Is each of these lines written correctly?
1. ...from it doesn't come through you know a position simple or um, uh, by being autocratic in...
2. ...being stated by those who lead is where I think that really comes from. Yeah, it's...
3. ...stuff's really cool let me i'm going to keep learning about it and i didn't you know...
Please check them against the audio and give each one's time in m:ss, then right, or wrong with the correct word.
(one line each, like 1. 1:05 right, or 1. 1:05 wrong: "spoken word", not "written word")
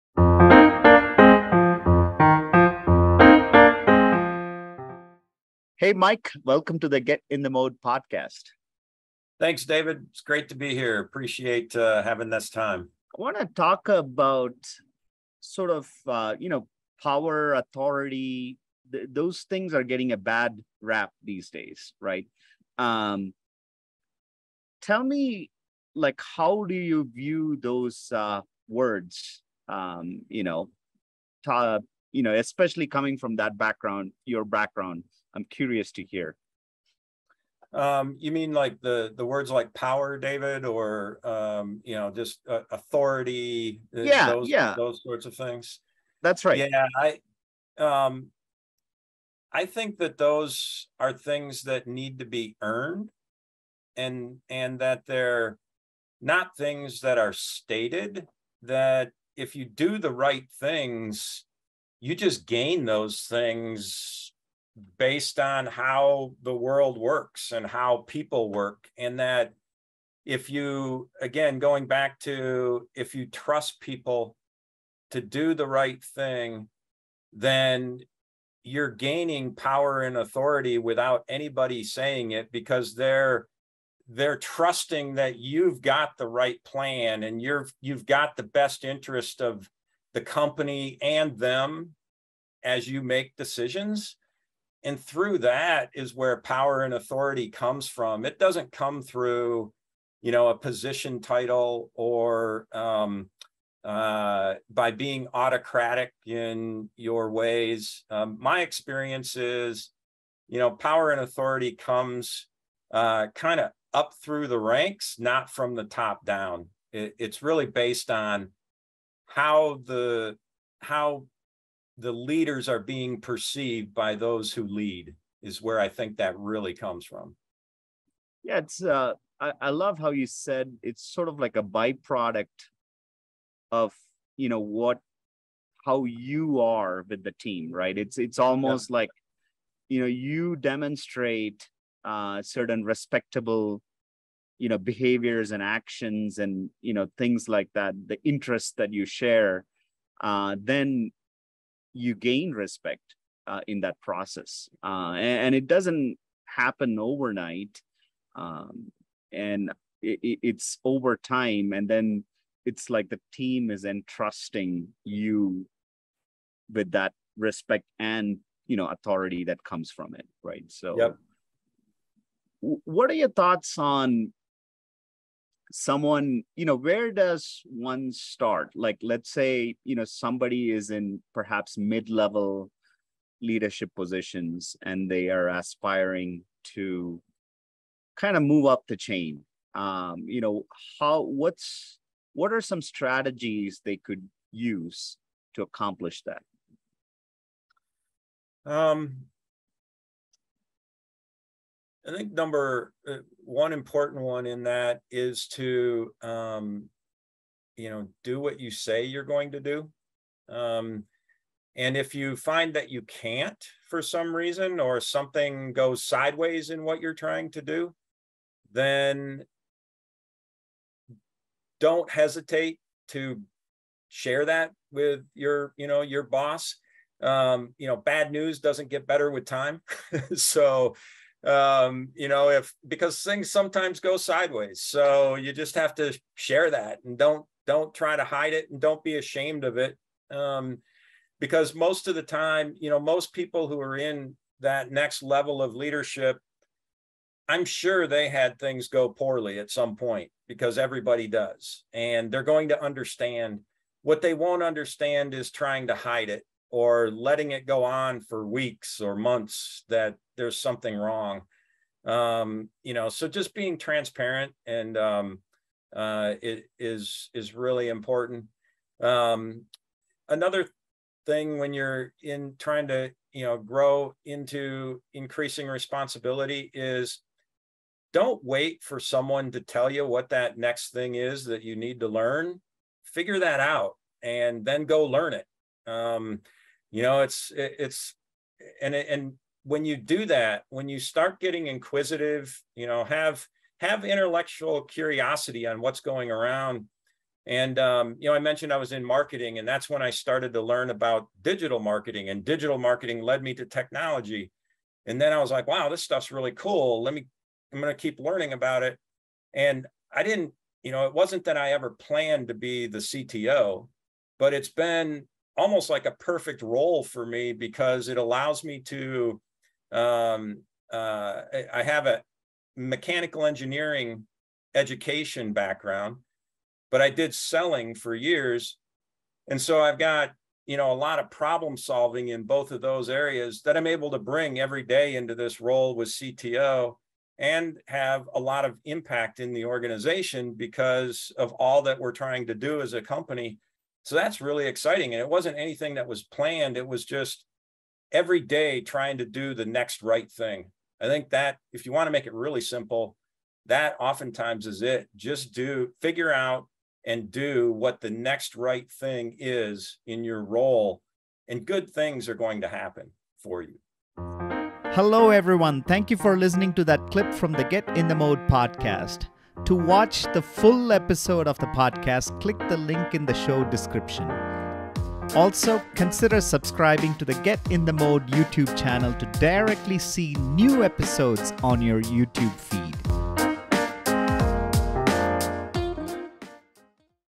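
1. 1:37 wrong: "title", not "simple"
2. 2:02 wrong: "perceived", not "stated"
3. 5:06 right.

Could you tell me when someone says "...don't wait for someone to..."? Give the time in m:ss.
4:38.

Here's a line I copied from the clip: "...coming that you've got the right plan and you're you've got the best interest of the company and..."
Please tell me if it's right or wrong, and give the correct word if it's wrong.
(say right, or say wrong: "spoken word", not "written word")
wrong: "trusting", not "coming".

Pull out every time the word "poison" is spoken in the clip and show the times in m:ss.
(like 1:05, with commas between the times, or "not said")
not said.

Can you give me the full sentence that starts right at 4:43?
Figure that out and then go learn it.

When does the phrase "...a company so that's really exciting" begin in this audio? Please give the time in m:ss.
5:42.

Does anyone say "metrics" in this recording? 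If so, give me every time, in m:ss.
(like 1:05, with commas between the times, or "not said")
not said.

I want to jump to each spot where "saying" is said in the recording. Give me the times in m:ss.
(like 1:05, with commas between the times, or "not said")
1:21.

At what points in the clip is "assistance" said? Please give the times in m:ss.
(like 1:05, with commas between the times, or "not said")
not said.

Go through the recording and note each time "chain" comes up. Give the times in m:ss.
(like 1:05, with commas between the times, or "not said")
3:08.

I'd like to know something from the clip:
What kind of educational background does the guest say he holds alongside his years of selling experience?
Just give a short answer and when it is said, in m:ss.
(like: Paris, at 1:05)
mechanical engineering, at 5:22.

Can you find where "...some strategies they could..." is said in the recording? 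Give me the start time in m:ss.
3:12.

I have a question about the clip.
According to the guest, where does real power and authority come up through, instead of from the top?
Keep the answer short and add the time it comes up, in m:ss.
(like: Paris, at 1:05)
the ranks, at 1:54.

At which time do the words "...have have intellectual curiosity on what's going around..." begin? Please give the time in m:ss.
4:53.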